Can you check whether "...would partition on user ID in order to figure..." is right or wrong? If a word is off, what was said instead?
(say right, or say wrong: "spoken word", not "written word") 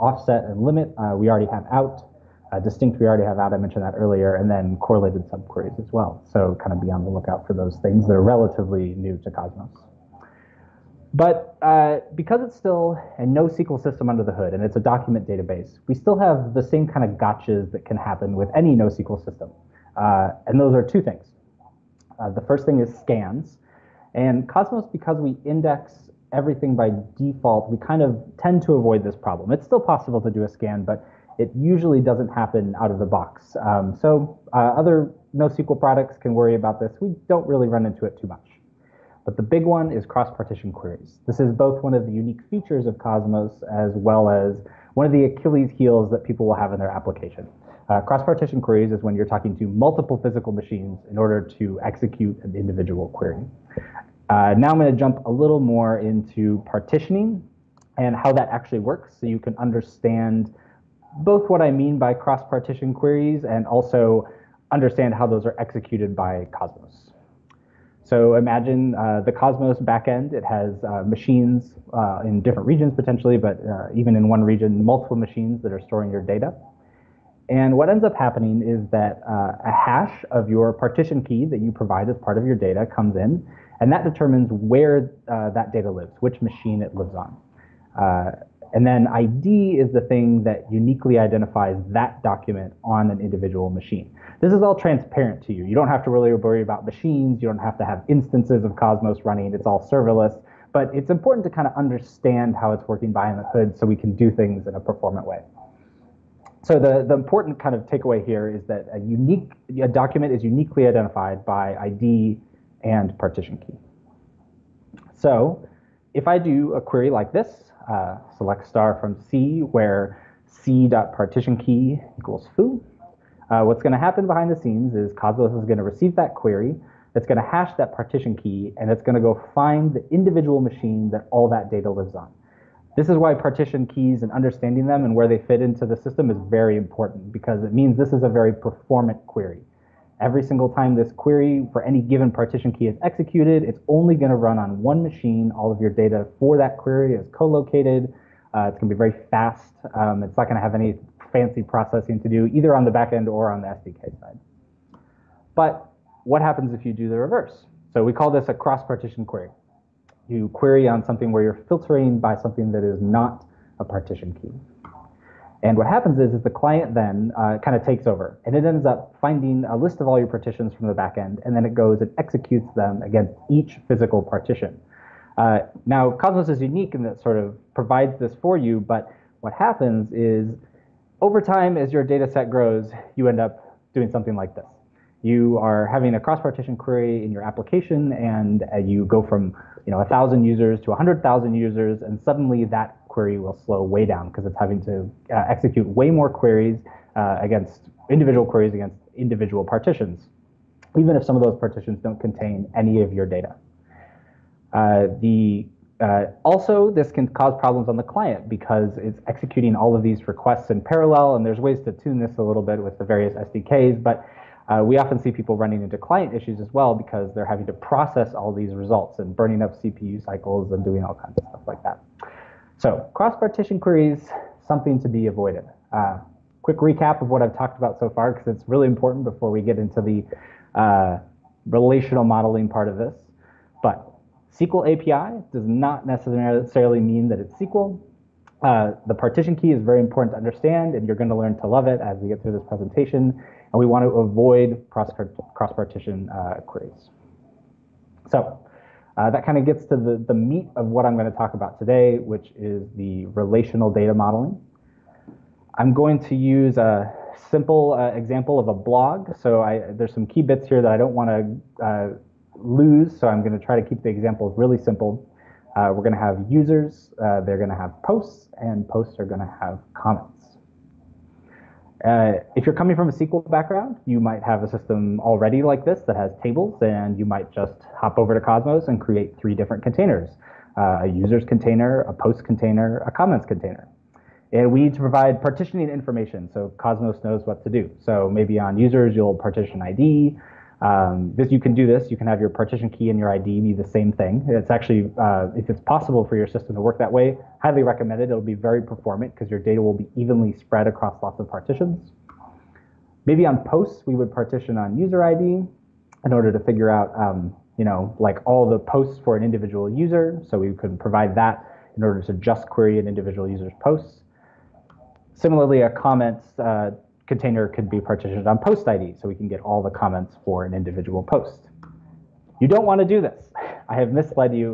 right.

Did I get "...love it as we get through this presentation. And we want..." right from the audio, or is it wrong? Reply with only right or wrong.
right.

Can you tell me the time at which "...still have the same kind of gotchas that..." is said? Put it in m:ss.
0:15.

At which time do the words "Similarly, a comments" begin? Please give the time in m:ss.
5:15.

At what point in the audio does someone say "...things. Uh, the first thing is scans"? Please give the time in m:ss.
0:21.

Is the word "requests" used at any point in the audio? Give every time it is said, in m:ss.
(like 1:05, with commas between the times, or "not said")
3:30.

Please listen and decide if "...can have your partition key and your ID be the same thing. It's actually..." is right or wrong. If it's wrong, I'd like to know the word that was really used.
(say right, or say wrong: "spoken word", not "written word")
right.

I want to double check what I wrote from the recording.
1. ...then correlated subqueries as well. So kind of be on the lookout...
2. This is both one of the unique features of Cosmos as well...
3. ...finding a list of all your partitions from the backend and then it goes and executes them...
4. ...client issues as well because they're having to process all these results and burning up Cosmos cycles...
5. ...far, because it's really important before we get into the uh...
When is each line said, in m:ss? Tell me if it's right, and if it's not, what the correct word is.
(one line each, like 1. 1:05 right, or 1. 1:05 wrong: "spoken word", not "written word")
1. 0:04 right
2. 0:41 right
3. 2:49 right
4. 3:35 wrong: "CPU", not "Cosmos"
5. 3:48 right.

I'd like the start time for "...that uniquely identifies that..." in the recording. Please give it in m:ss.
1:30.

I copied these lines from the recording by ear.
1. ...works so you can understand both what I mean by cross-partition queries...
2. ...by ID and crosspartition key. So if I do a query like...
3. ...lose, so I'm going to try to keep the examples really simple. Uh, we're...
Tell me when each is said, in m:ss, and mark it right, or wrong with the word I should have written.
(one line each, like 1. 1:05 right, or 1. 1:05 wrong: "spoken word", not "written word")
1. 0:58 right
2. 1:51 wrong: "partition", not "crosspartition"
3. 4:22 right.